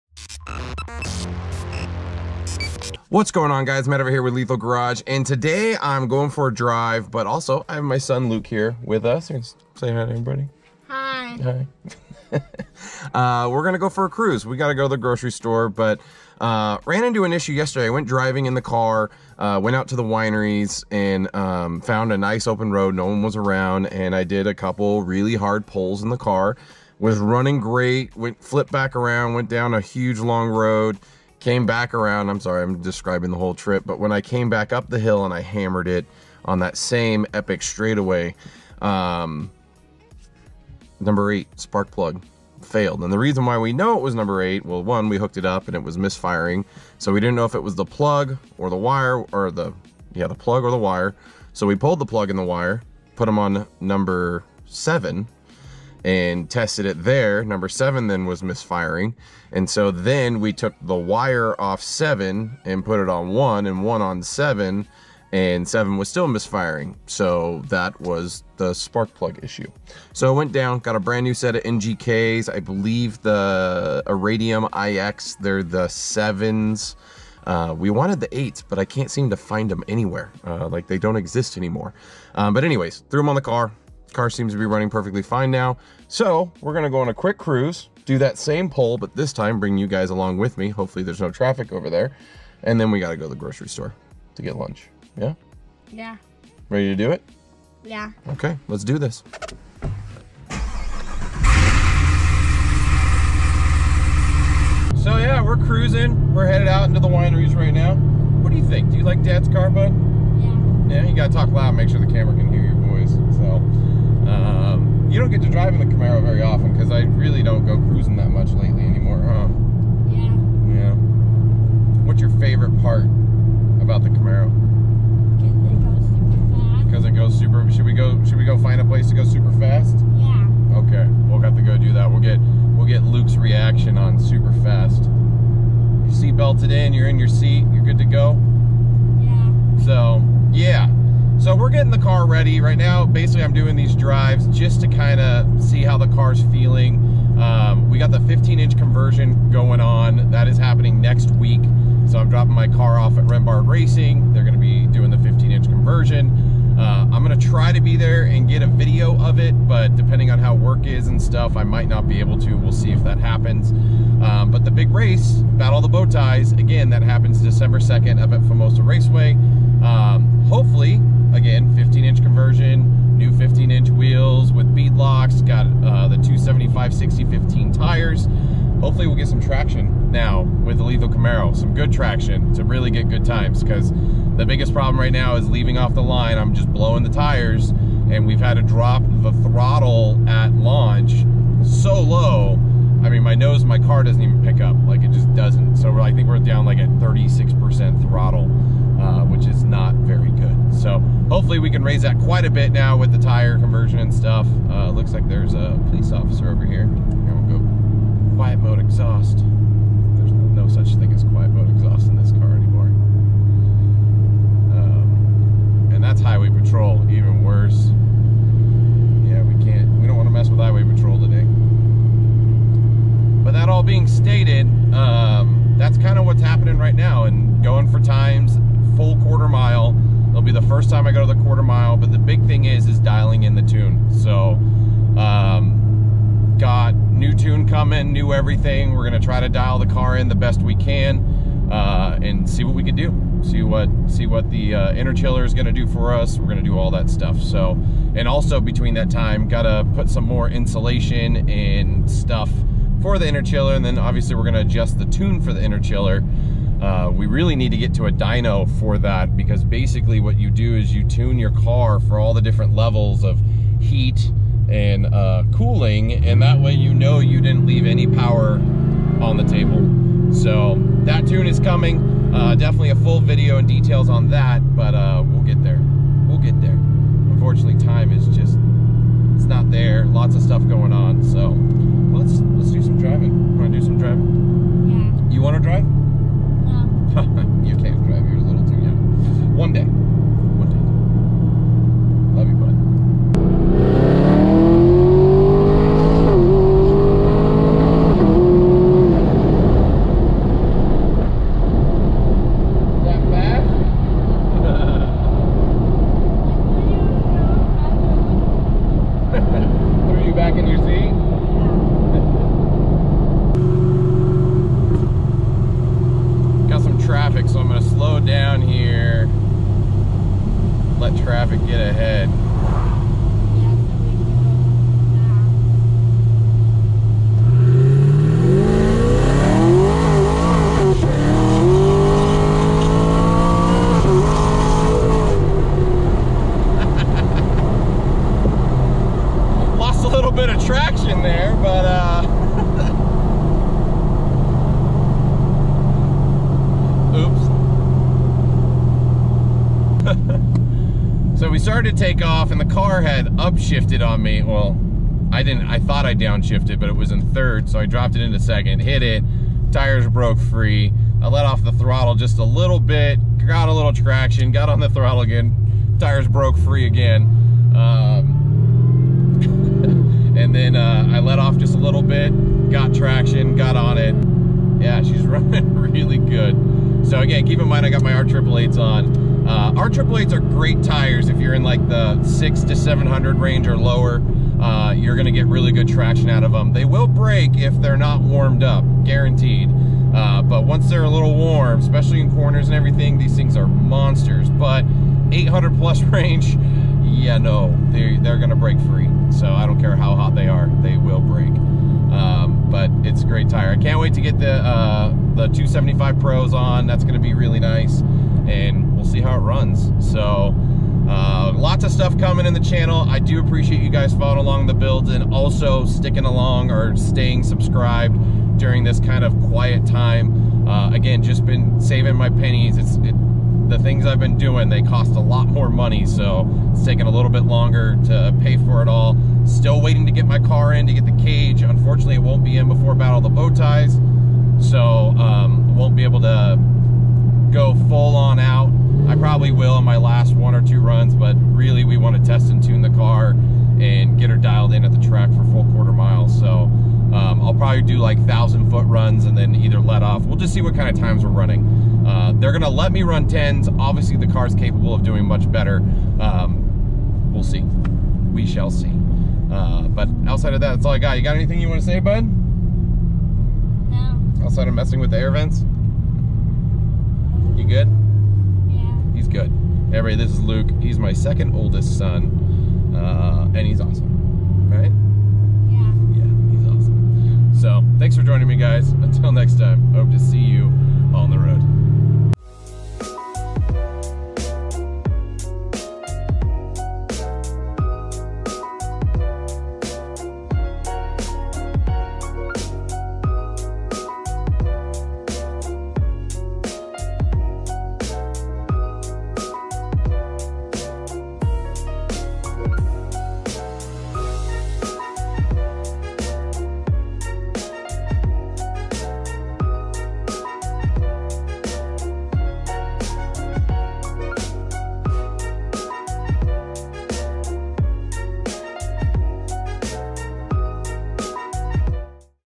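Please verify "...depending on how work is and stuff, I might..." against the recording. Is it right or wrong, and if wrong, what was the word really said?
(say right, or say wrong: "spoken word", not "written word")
right.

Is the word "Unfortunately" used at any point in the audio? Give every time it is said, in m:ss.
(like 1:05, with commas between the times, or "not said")
4:37, 7:11.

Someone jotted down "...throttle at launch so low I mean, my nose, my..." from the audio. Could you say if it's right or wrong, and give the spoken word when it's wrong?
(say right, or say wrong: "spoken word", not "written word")
right.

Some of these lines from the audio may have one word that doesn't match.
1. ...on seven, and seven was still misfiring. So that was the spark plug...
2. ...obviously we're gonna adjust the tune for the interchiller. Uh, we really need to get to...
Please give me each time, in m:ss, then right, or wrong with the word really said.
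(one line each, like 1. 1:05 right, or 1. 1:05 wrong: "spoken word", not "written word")
1. 1:04 right
2. 4:13 right.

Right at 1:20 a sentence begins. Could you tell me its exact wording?
Uh, like they don't exist anymore.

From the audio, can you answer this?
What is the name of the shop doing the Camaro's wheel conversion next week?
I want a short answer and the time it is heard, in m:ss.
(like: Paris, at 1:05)
Rembard Racing, at 2:33.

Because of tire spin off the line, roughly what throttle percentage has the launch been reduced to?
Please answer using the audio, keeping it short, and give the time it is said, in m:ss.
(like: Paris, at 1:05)
36%, at 3:16.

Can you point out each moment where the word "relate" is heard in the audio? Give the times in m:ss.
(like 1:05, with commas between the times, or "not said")
not said.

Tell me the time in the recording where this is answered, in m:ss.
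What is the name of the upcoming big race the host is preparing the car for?
2:45.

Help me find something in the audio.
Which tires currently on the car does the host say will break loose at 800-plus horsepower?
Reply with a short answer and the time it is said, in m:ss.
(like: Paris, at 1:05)
R888s, at 6:18.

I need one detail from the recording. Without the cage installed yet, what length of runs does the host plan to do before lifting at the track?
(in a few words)
1,000 foot.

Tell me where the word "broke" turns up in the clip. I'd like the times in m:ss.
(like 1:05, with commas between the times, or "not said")
6:00, 6:06.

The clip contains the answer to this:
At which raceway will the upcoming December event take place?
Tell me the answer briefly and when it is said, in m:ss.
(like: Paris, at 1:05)
Famoso Raceway, at 2:48.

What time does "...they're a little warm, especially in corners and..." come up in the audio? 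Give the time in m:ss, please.
6:30.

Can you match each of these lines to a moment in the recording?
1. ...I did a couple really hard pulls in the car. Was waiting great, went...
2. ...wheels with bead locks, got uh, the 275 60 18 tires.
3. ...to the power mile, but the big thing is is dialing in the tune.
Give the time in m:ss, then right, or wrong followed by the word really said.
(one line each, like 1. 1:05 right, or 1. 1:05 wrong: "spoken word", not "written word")
1. 0:24 wrong: "running", not "waiting"
2. 2:53 wrong: "15", not "18"
3. 3:51 wrong: "quarter", not "power".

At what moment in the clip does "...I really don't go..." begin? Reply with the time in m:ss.
1:56.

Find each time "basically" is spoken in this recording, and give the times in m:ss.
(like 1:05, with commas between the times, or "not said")
2:23, 4:19.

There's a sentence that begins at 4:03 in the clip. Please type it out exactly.
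See what see what the uh, interchiller is gonna do for us.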